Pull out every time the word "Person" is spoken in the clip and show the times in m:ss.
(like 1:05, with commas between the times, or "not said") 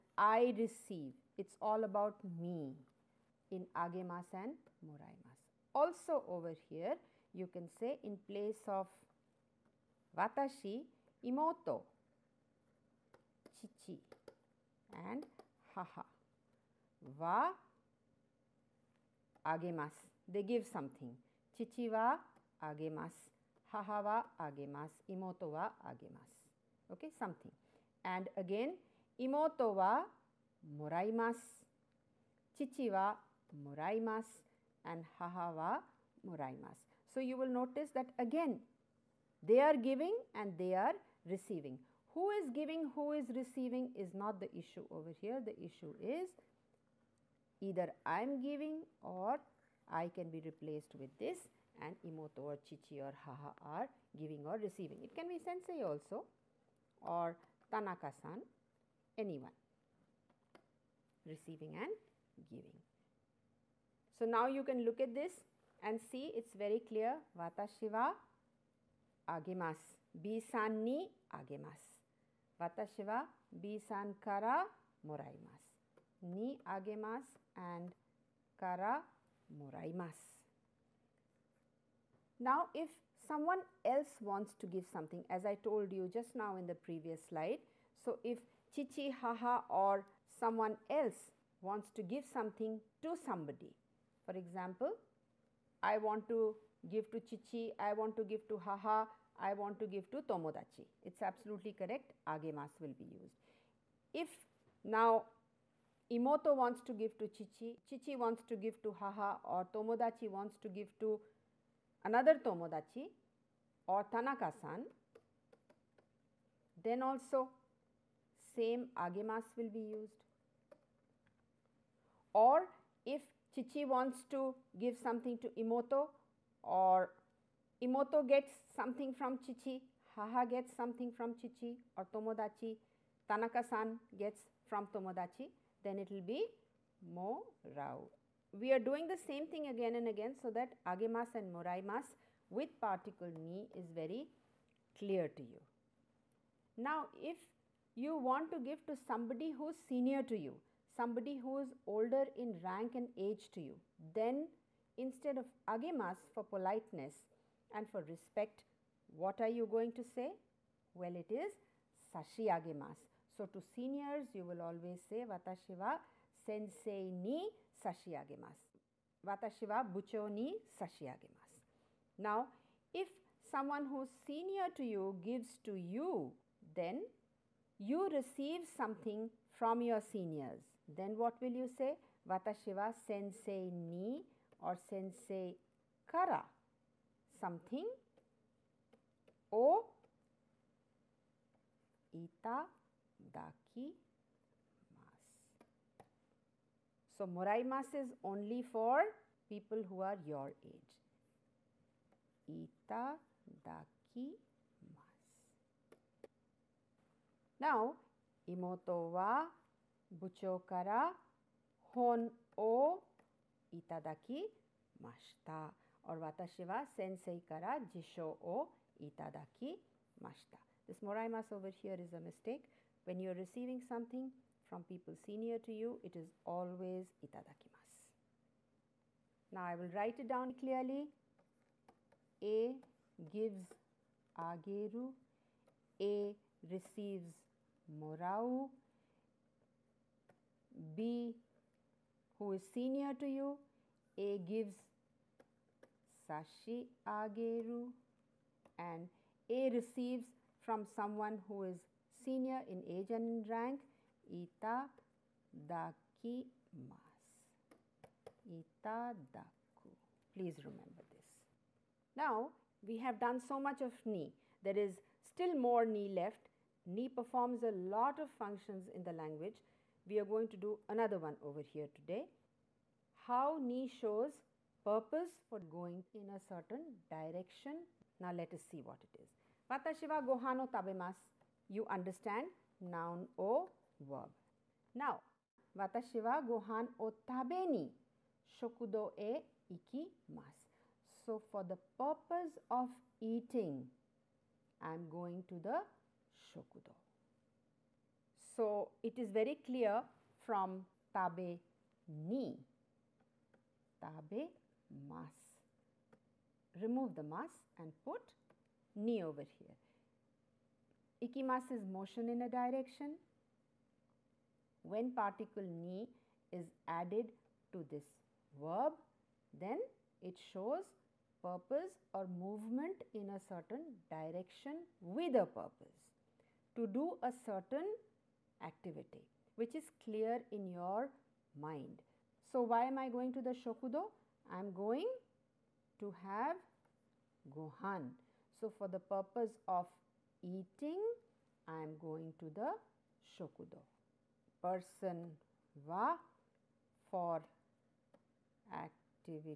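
5:44.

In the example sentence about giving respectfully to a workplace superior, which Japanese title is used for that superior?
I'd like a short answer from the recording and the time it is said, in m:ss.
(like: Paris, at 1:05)
bucho, at 2:49.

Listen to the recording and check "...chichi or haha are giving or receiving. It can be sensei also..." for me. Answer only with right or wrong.
right.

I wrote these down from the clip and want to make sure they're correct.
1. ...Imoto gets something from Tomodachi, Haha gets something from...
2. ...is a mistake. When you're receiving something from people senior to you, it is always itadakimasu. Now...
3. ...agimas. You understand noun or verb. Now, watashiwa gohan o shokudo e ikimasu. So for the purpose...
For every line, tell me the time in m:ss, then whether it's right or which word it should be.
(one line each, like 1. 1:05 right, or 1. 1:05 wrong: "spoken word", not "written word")
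1. 2:07 wrong: "Chichi", not "Tomodachi"
2. 3:41 right
3. 4:40 wrong: "tabemas", not "agimas".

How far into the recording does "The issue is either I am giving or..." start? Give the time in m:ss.
0:45.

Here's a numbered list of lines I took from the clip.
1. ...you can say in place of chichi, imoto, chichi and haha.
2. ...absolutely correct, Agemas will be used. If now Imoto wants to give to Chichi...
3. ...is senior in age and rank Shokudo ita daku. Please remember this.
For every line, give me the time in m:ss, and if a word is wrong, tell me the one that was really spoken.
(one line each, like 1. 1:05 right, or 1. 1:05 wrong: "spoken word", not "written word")
1. 0:07 wrong: "watashi", not "chichi"
2. 1:41 right
3. 4:11 wrong: "Ita", not "Shokudo".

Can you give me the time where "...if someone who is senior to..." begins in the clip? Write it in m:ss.
2:52.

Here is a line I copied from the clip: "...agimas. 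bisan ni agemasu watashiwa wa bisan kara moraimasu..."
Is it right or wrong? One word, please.
right.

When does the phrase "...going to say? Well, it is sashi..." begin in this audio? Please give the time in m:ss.
2:39.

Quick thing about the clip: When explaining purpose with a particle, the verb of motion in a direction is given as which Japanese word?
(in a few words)
ikimasu.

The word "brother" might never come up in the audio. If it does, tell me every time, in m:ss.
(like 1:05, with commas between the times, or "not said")
not said.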